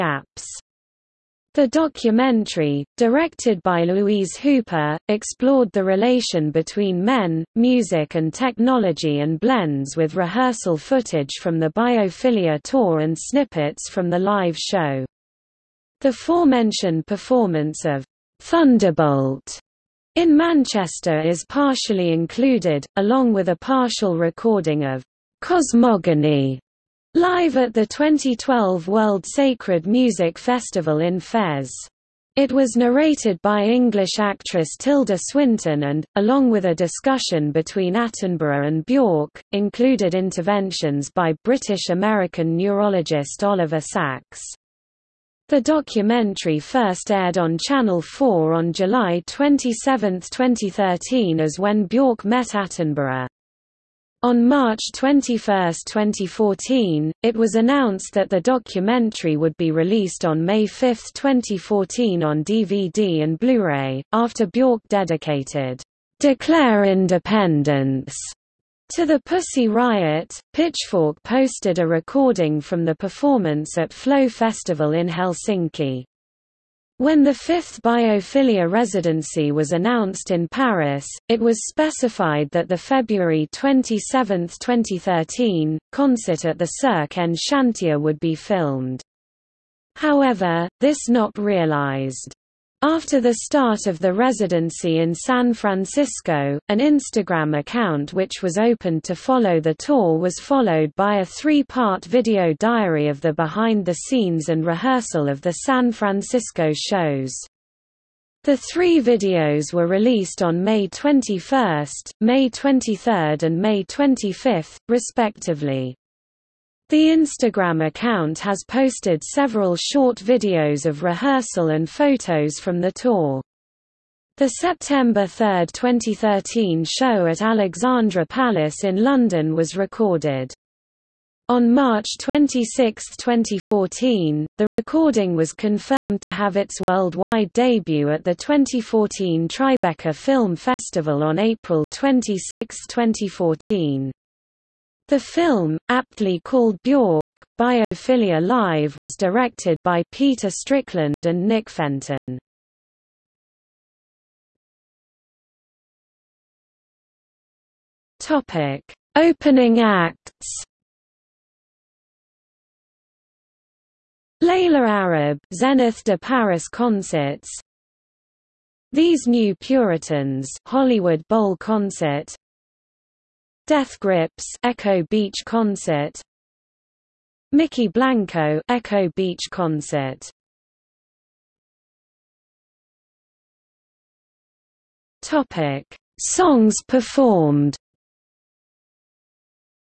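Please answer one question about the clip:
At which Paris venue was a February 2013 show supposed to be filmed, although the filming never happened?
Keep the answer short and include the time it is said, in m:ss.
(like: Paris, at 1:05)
Cirque en Chantier, at 1:26.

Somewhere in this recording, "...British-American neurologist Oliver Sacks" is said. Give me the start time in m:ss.
0:41.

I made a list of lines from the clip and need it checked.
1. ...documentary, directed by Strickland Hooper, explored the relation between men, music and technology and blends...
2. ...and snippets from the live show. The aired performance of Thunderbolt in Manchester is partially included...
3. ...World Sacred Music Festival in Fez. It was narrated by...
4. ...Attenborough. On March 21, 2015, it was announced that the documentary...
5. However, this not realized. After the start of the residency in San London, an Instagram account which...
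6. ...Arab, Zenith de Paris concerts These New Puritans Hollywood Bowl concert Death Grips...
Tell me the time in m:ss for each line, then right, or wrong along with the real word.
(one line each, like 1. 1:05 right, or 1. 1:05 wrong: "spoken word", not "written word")
1. 0:01 wrong: "Louise", not "Strickland"
2. 0:12 wrong: "forementioned", not "aired"
3. 0:28 right
4. 0:52 wrong: "2014", not "2015"
5. 1:29 wrong: "Francisco", not "London"
6. 2:44 right.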